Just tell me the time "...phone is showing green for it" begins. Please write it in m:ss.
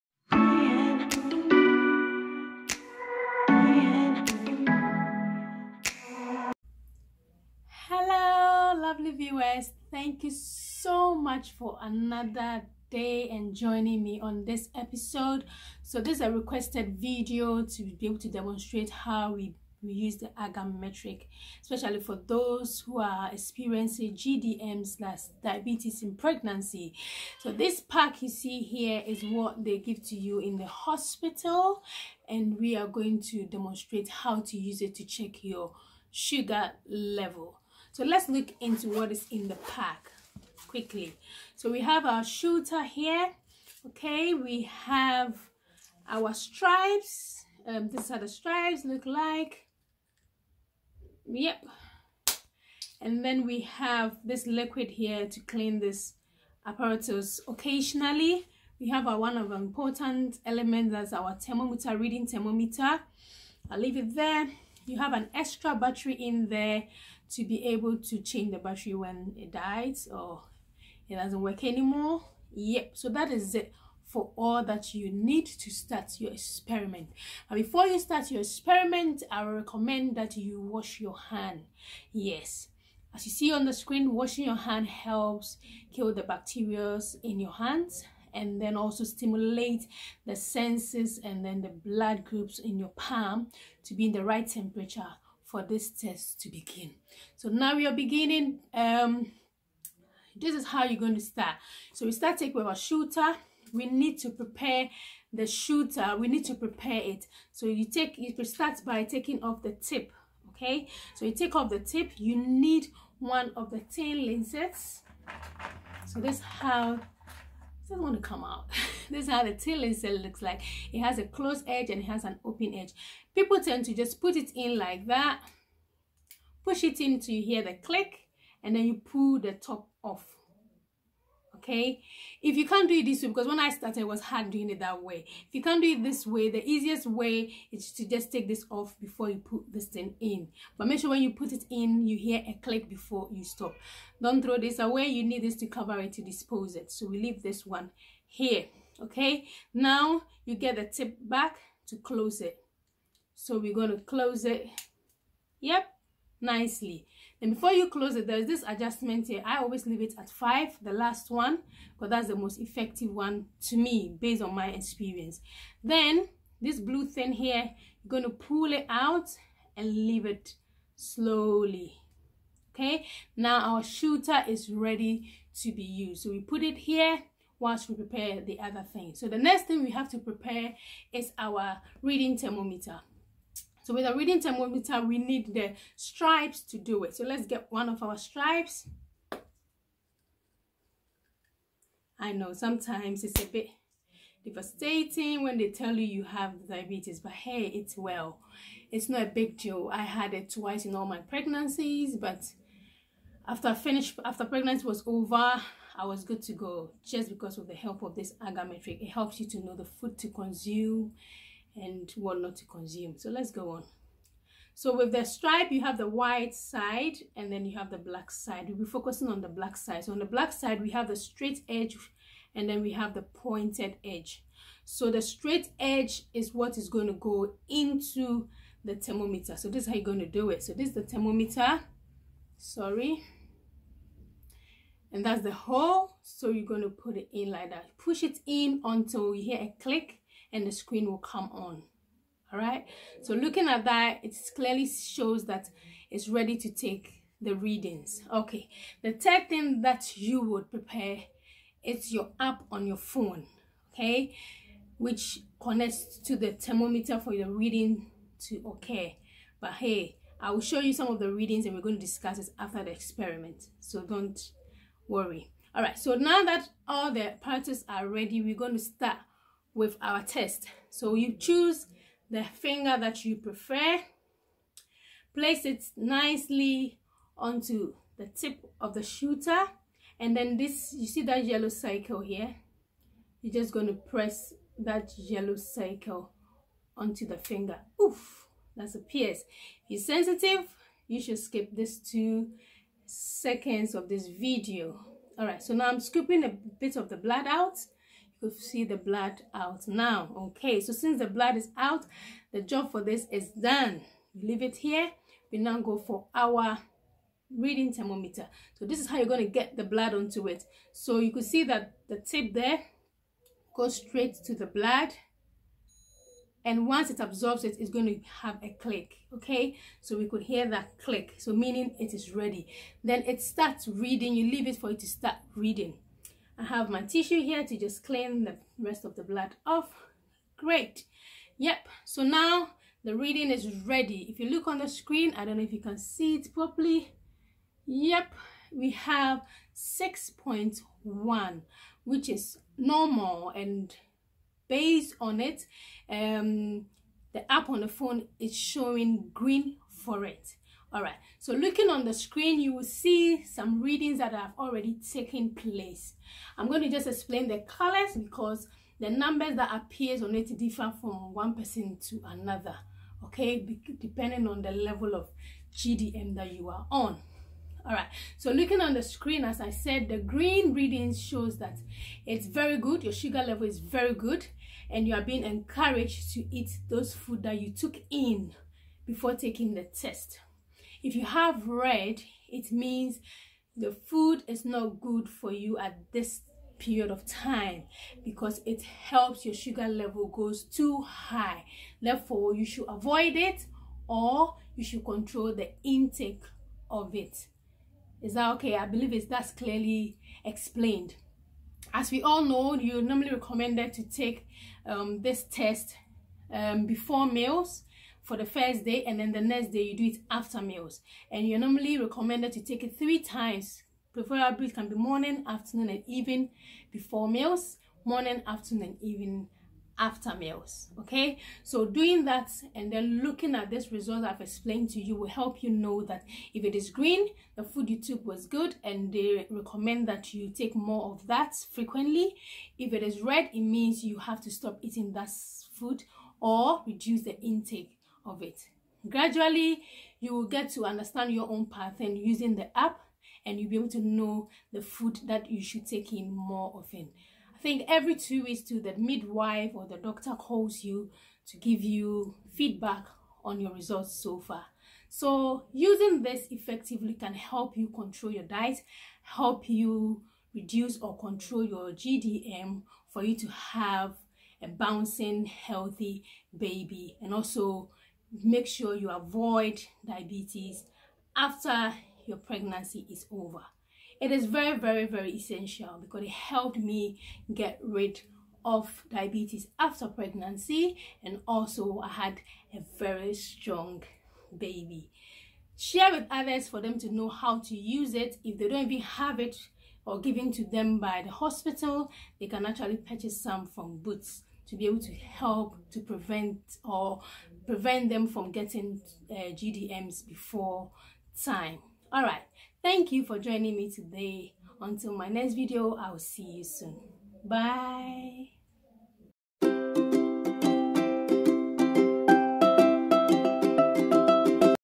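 5:47.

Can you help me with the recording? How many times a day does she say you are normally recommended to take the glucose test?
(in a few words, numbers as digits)
3.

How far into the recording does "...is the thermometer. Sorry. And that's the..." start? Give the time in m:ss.
3:50.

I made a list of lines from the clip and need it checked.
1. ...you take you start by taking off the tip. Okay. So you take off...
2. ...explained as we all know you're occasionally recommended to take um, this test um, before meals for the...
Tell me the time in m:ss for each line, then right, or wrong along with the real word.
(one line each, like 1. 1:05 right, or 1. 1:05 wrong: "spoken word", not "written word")
1. 1:47 right
2. 6:40 wrong: "normally", not "occasionally".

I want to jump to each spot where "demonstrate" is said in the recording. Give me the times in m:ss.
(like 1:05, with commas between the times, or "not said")
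0:18, 0:33.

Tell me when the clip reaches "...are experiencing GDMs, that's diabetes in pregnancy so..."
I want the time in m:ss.
0:22.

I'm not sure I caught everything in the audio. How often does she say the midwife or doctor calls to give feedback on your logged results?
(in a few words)
Every 2 weeks.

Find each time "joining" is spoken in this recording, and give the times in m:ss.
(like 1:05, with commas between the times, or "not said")
0:13, 8:23.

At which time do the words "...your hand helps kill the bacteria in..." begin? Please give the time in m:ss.
1:24.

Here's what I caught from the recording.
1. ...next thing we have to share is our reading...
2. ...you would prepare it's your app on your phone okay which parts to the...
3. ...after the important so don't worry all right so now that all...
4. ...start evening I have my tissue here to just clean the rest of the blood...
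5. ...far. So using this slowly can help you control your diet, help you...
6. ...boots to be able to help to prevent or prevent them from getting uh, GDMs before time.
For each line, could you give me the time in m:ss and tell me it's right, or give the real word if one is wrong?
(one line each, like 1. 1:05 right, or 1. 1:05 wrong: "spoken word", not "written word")
1. 2:59 wrong: "prepare", not "share"
2. 4:10 wrong: "connects", not "parts"
3. 4:22 wrong: "experiment", not "important"
4. 5:25 wrong: "reading", not "evening"
5. 7:34 wrong: "effectively", not "slowly"
6. 8:13 right.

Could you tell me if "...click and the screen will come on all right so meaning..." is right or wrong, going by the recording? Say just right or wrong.
wrong.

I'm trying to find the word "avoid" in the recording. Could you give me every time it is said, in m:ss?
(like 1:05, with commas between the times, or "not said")
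6:32, 7:49.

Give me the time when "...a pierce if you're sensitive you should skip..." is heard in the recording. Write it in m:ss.
4:48.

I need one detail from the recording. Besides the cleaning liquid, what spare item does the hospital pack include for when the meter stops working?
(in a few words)
Extra battery.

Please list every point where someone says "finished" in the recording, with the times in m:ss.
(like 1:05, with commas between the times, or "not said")
3:23.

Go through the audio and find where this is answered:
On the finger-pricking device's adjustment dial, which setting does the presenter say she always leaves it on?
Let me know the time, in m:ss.
2:40.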